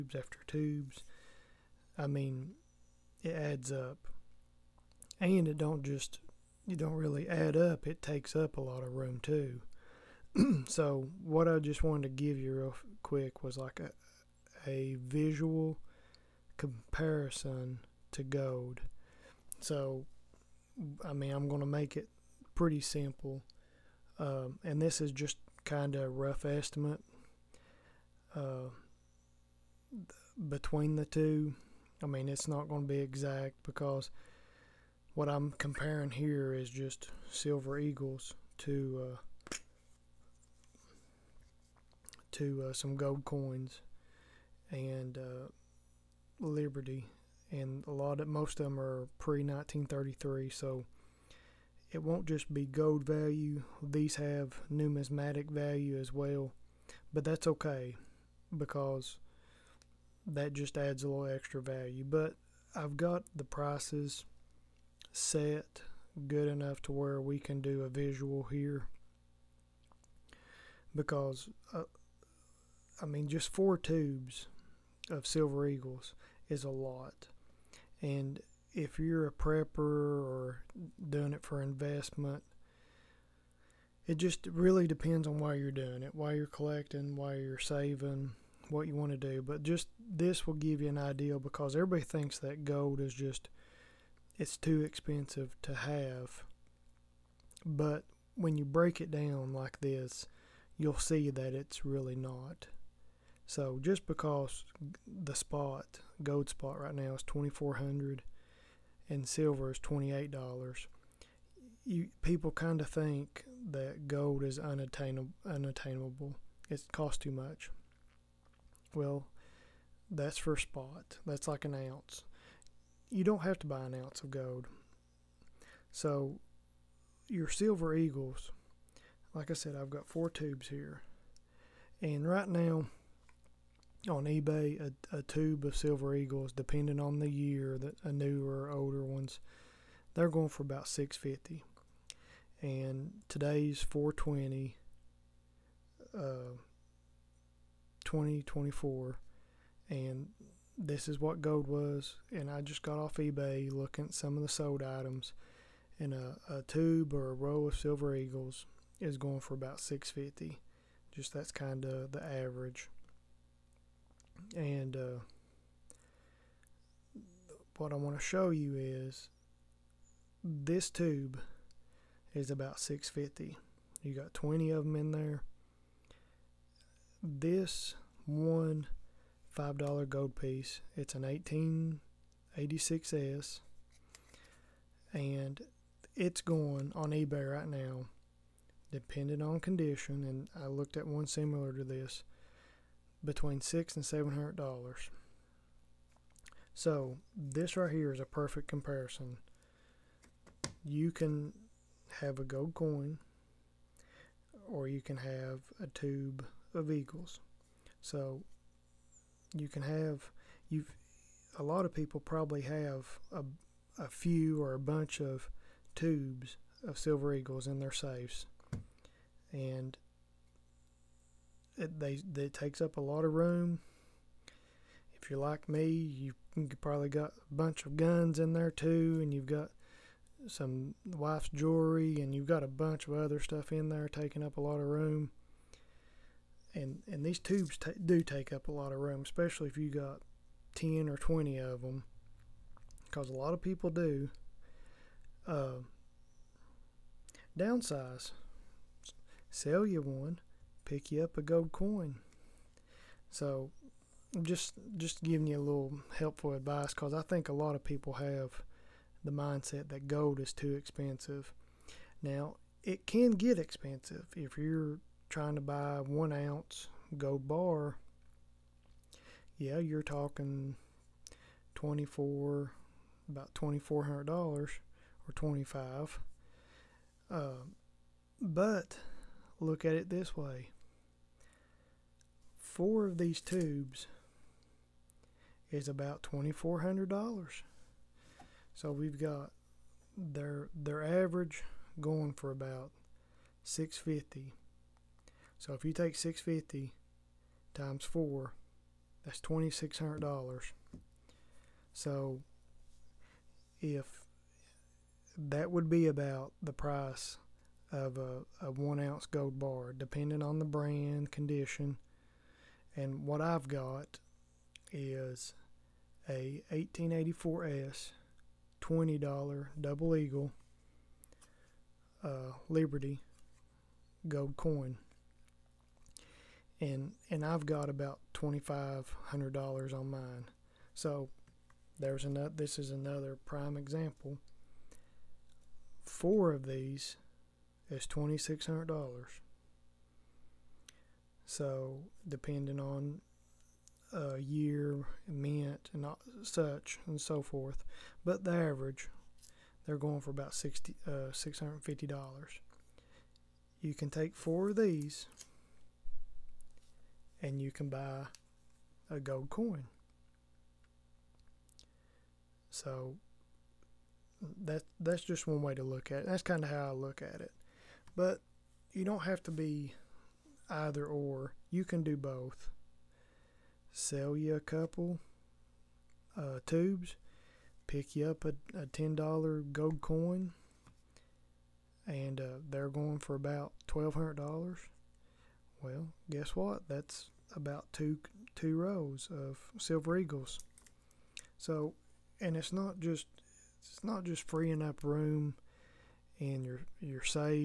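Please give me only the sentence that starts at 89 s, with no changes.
But just this will give you an idea because everybody thinks that gold is just it's too expensive to have.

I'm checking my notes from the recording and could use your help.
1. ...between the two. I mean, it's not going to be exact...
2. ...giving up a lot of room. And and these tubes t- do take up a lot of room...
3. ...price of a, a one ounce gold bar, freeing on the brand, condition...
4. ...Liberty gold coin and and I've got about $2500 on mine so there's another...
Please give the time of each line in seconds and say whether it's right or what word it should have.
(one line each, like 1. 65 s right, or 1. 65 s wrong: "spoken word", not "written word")
1. 30 s right
2. 234 s wrong: "taking", not "giving"
3. 306 s wrong: "depending", not "freeing"
4. 322 s right.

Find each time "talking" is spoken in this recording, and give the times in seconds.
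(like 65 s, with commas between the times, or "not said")
270 s.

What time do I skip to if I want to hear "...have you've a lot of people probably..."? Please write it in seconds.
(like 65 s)
209 s.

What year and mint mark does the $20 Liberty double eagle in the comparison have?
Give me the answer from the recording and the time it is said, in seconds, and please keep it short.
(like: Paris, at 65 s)
1884S, at 316 s.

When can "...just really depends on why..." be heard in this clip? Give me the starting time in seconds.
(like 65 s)
84 s.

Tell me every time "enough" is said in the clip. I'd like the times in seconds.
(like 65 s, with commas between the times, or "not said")
66 s.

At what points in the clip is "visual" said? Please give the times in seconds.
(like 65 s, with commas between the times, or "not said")
15 s, 67 s.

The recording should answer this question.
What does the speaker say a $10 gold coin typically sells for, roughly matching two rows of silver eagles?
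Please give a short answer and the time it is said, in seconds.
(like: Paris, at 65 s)
$1,200, at 383 s.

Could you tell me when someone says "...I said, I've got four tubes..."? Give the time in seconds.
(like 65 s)
129 s.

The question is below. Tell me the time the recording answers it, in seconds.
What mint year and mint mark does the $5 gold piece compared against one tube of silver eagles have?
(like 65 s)
182 s.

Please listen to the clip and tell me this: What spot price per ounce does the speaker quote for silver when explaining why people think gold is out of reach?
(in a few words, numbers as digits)
$28.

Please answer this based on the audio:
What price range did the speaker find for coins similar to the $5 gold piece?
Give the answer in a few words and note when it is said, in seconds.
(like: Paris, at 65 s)
between 600 and 700 dollars, at 193 s.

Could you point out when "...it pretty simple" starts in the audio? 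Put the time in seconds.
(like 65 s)
21 s.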